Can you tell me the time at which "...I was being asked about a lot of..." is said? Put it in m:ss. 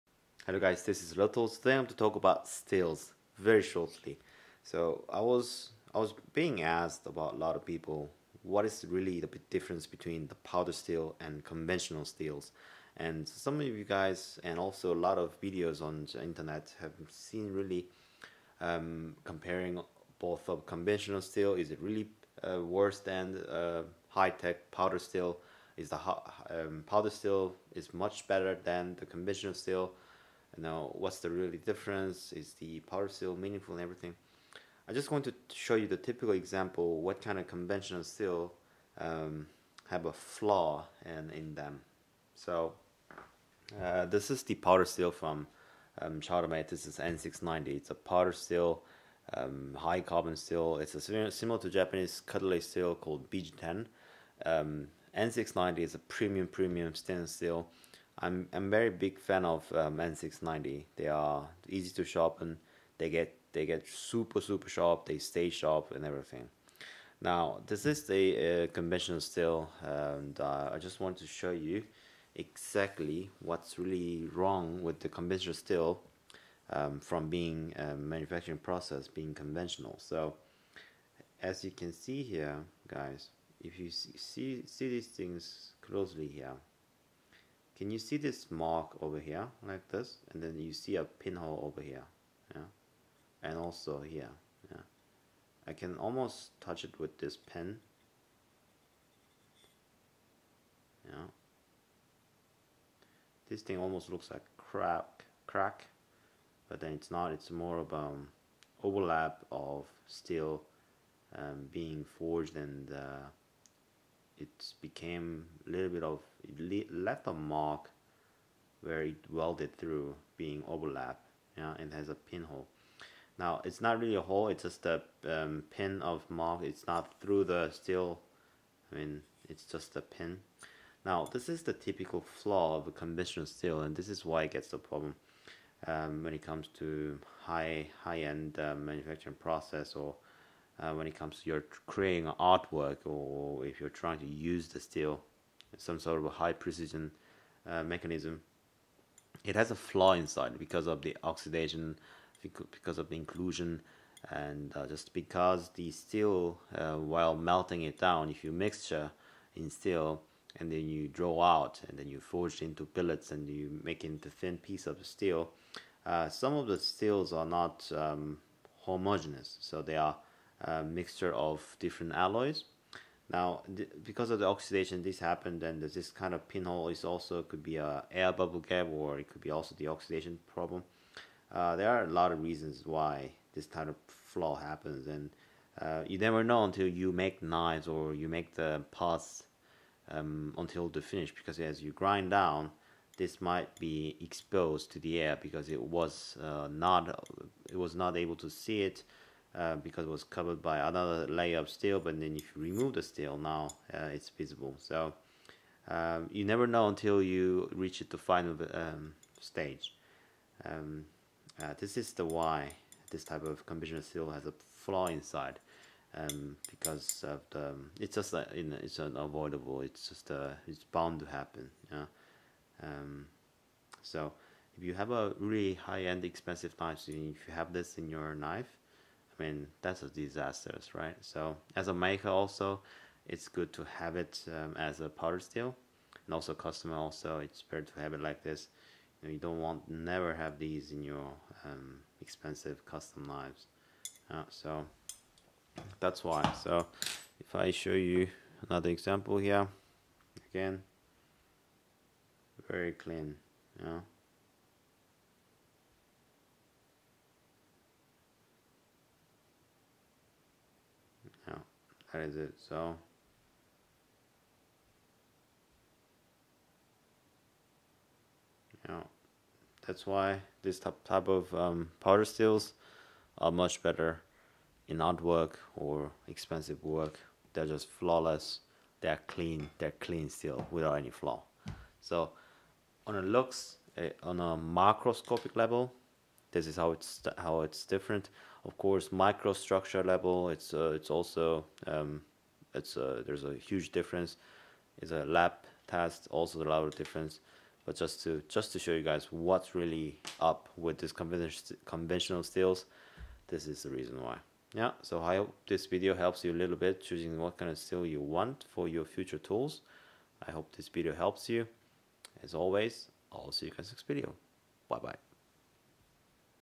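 0:05.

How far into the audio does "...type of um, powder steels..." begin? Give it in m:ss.
4:31.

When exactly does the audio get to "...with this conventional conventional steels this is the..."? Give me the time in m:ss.
5:00.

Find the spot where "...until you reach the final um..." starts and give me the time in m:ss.
3:26.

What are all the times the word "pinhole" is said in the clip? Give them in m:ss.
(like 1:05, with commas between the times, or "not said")
1:31, 2:02, 2:56.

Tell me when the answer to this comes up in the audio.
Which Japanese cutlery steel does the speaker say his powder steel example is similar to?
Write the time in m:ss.
0:53.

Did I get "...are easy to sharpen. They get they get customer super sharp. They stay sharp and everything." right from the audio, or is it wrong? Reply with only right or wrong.
wrong.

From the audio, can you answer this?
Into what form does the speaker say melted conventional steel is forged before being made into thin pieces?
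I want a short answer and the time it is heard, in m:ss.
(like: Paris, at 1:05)
billets, at 2:42.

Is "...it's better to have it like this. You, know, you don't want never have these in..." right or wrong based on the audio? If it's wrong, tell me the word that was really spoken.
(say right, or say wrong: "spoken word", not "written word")
right.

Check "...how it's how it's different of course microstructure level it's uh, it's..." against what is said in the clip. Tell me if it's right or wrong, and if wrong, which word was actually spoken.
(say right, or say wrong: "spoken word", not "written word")
right.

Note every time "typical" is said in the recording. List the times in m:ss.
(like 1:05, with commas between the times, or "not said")
0:35, 2:11.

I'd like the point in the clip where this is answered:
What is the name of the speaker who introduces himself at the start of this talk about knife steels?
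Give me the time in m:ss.
0:01.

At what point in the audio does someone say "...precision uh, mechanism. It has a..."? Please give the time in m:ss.
2:26.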